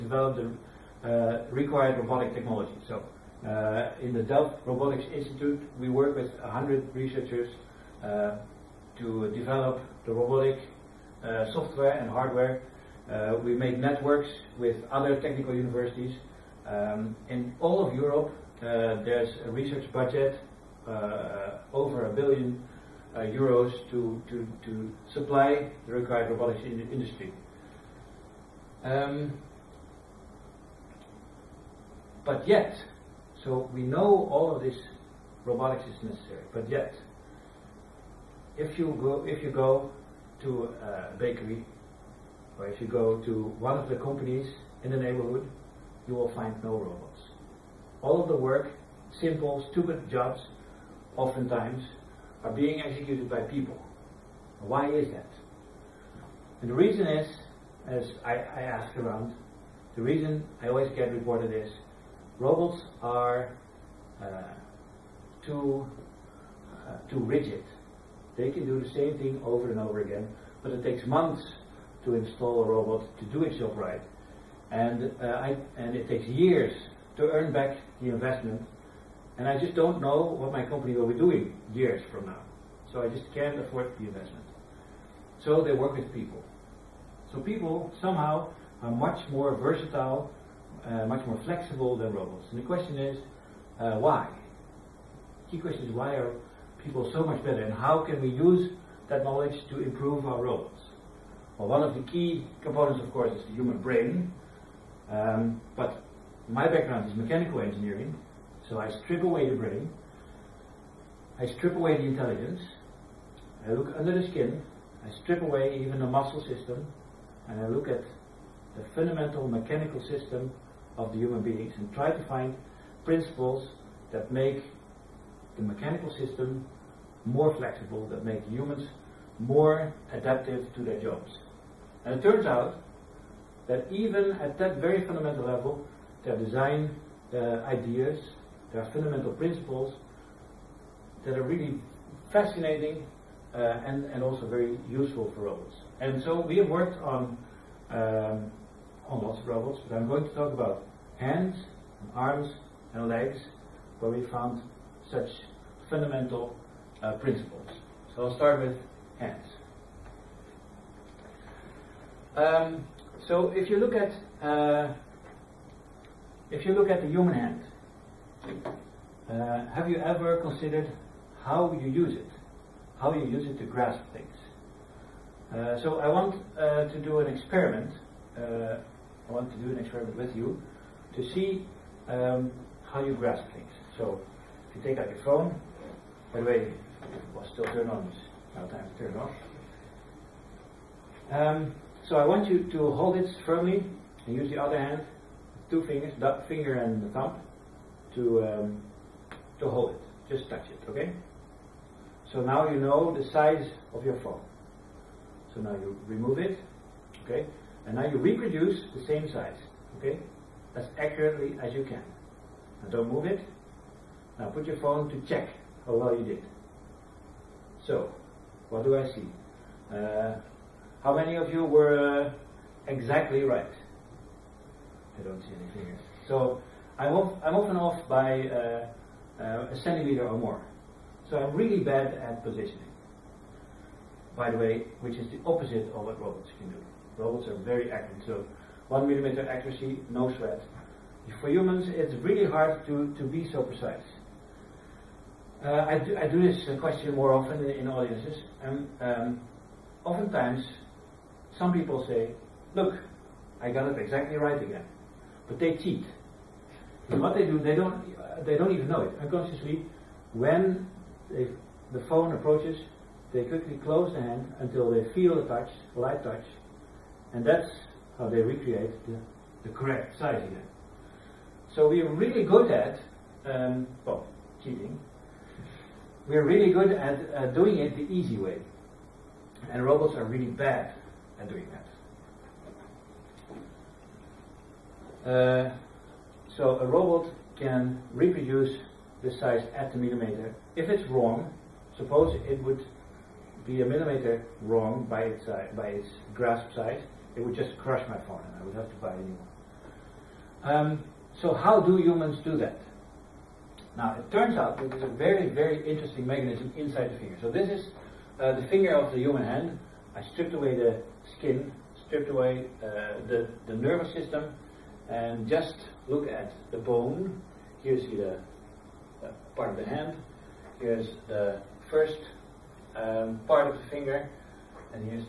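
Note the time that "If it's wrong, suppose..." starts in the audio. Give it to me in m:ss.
4:50.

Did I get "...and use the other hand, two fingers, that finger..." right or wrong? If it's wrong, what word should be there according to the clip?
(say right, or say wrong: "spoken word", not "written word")
right.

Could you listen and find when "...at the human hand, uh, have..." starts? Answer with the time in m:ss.
2:46.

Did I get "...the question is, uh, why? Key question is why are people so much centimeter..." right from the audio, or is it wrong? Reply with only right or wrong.
wrong.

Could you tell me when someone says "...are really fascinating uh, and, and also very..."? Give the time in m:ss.
2:21.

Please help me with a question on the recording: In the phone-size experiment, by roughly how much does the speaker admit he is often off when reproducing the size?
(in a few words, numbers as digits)
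a centimeter.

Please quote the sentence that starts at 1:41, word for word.
Well, one of the key components, of course, is the human brain.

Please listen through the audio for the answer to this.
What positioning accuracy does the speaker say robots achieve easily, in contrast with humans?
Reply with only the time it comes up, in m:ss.
3:58.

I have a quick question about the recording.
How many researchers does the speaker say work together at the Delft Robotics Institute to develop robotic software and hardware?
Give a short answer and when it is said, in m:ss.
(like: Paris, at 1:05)
100, at 0:06.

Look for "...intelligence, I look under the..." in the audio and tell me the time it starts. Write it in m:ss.
1:52.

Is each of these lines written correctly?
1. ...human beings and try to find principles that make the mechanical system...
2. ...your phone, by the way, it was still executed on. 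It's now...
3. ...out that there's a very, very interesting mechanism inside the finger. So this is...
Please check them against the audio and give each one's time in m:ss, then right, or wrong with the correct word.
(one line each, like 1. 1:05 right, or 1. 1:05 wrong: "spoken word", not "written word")
1. 2:01 right
2. 3:05 wrong: "turned", not "executed"
3. 5:04 right.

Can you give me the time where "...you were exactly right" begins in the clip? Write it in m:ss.
3:41.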